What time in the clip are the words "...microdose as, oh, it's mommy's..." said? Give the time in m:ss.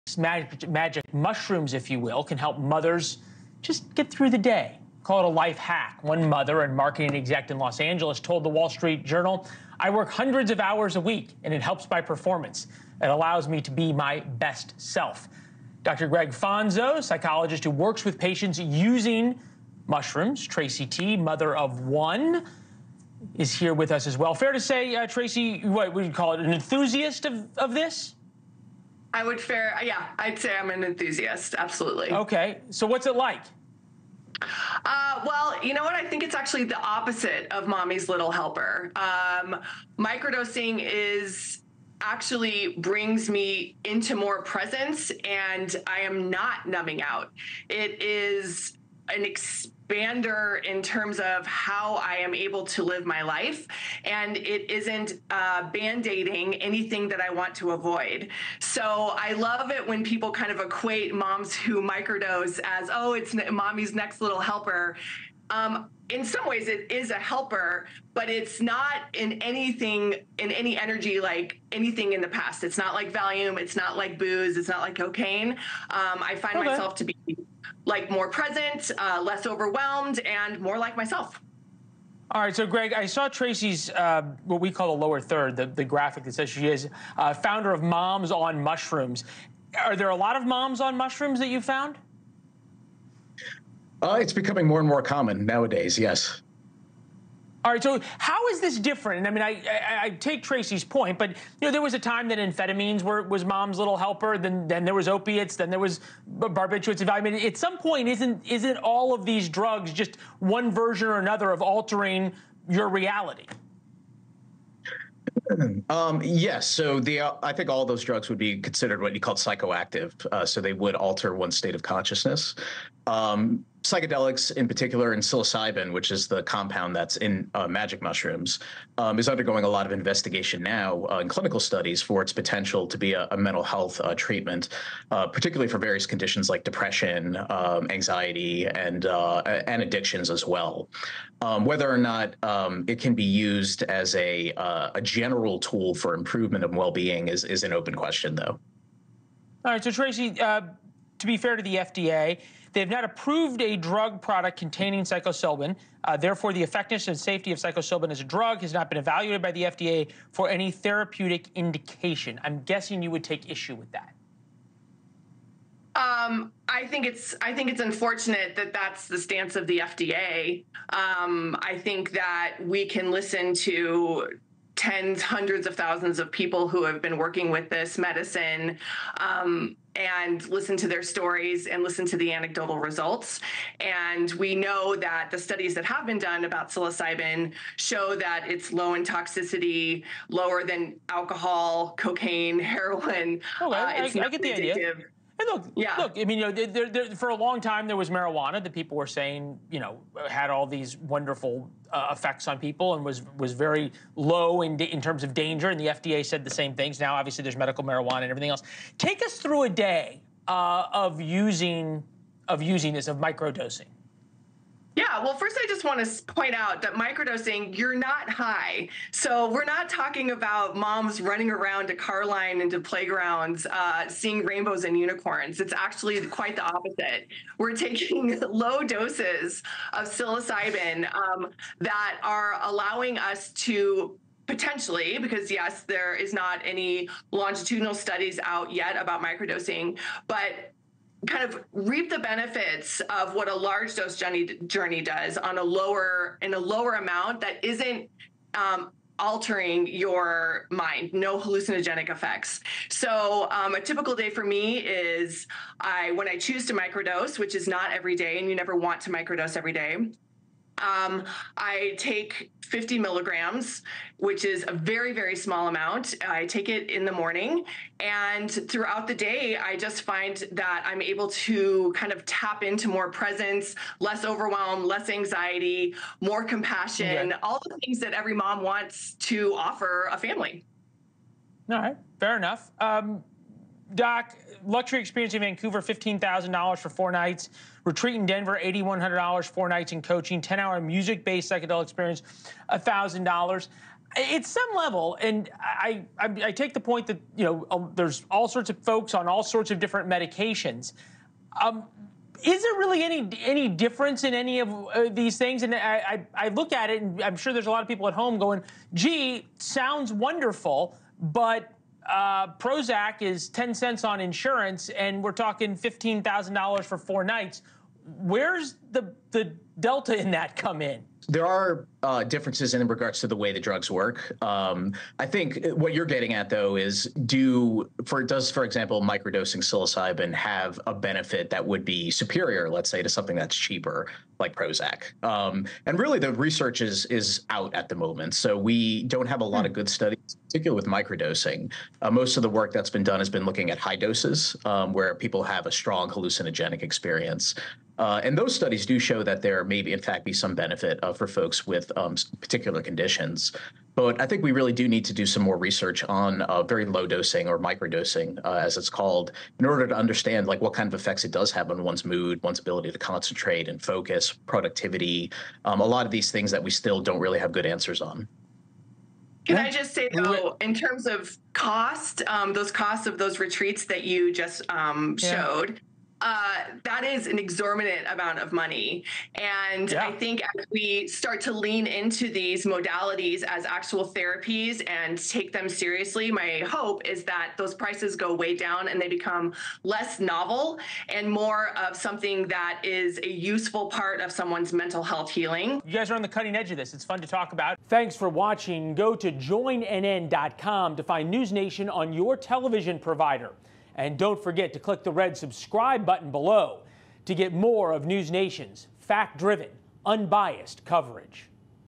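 1:01.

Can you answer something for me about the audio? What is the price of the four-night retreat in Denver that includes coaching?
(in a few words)
$8,100.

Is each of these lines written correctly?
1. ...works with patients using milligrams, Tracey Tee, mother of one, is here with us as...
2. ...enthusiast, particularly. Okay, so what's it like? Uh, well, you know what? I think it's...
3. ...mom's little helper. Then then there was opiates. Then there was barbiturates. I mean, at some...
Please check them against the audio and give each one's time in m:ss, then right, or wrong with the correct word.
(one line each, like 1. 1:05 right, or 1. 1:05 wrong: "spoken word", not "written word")
1. 0:17 wrong: "mushrooms", not "milligrams"
2. 0:30 wrong: "absolutely", not "particularly"
3. 1:43 right.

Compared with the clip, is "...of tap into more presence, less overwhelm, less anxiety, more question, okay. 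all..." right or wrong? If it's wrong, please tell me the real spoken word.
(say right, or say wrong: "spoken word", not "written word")
wrong: "compassion", not "question".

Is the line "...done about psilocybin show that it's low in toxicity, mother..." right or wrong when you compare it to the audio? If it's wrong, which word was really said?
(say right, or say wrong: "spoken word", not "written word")
wrong: "lower", not "mother".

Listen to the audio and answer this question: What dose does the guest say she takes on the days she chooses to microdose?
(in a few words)
50 milligrams.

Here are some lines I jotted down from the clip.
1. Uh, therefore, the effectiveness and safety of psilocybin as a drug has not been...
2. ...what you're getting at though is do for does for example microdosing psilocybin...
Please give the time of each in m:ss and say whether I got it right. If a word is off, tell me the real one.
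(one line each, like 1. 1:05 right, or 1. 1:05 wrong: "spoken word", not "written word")
1. 2:36 right
2. 5:25 right.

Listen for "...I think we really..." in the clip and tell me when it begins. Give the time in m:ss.
5:54.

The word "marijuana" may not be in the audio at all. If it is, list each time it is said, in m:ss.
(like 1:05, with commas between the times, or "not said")
3:18, 3:27.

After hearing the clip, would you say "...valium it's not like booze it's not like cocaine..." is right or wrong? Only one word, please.
right.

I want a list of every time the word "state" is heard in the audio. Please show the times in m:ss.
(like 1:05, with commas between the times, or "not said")
2:01.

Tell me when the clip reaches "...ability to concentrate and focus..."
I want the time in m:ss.
6:02.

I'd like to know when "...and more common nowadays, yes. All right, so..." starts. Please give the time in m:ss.
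1:34.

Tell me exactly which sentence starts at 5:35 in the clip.
Um, and really, the research is is out at the moment, so we don't have a lot of hmm.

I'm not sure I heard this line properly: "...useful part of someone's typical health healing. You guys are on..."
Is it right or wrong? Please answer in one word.
wrong.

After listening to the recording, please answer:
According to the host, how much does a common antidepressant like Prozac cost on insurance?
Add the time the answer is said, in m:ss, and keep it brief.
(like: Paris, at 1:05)
10 cents, at 5:13.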